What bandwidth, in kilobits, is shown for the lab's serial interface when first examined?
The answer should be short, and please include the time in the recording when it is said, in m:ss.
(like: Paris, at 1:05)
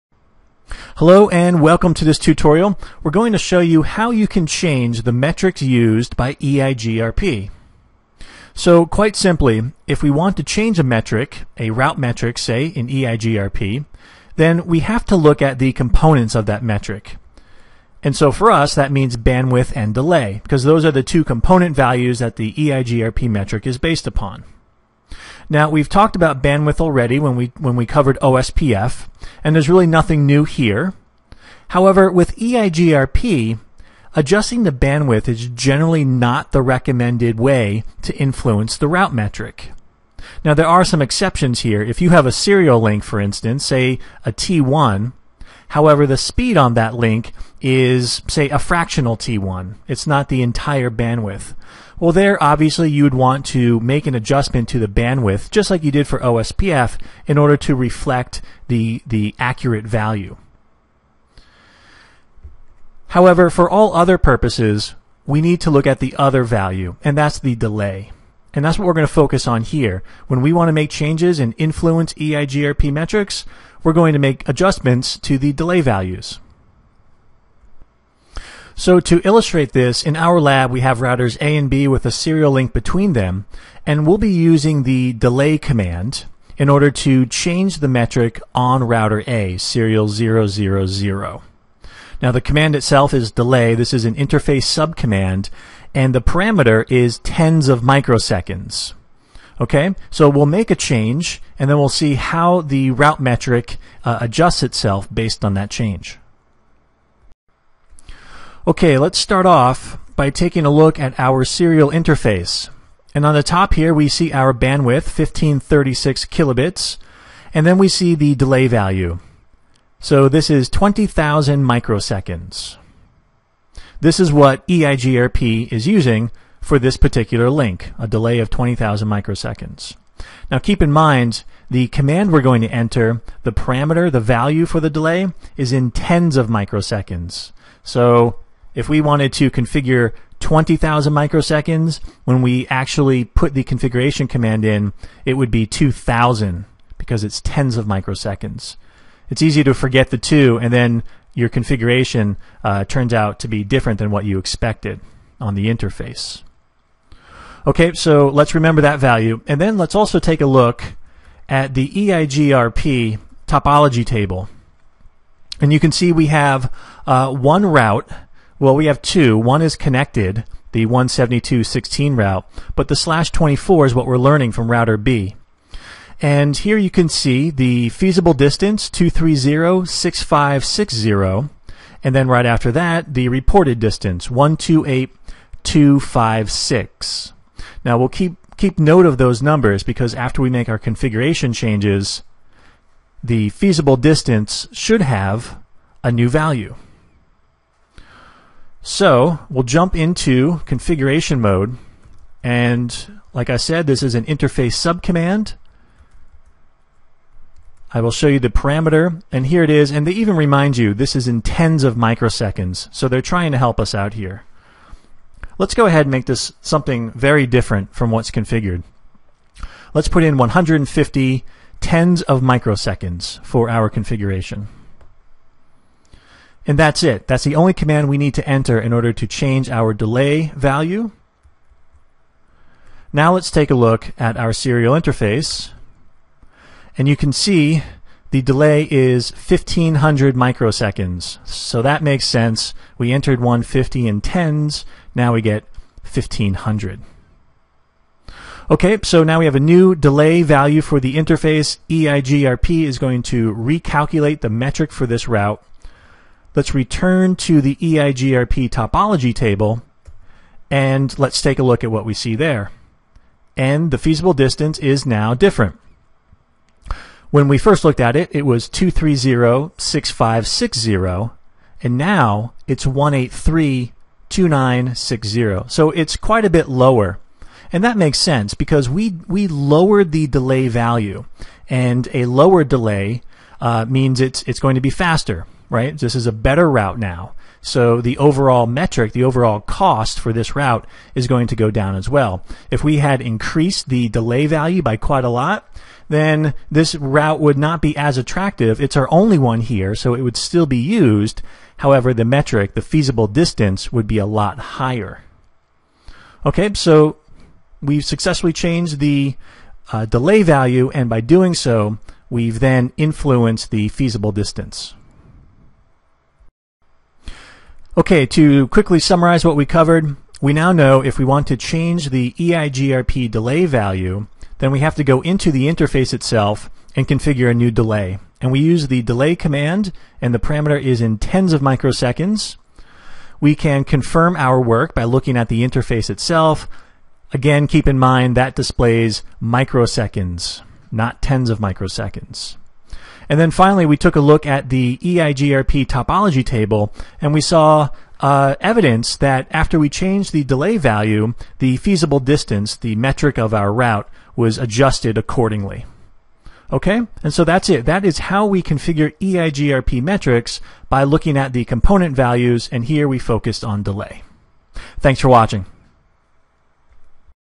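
1536, at 1:55.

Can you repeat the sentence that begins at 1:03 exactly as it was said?
However, for all other purposes, we need to look at the other value, and that's the delay.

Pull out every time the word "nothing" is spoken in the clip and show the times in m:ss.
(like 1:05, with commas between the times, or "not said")
0:29.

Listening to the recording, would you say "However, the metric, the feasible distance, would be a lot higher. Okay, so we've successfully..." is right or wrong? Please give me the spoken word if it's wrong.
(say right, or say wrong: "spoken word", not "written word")
right.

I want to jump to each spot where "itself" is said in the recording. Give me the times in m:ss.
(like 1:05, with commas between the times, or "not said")
1:32, 1:44, 5:26, 5:36.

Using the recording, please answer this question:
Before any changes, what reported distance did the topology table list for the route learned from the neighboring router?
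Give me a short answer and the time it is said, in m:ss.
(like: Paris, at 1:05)
128256, at 3:04.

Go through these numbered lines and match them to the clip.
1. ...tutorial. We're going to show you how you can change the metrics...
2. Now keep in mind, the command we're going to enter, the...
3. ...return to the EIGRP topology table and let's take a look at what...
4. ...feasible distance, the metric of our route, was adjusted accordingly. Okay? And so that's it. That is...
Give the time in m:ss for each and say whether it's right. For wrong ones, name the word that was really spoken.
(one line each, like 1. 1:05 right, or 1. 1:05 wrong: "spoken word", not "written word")
1. 0:02 right
2. 2:10 right
3. 4:16 right
4. 5:51 right.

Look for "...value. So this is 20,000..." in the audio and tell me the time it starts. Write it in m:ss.
1:58.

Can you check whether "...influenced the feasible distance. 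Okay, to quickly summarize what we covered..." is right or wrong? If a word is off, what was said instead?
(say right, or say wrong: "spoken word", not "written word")
right.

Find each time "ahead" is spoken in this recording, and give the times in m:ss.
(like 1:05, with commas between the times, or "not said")
3:35.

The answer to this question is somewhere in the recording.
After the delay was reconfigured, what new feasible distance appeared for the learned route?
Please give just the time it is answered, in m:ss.
4:32.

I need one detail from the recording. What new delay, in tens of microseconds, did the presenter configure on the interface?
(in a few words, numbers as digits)
150.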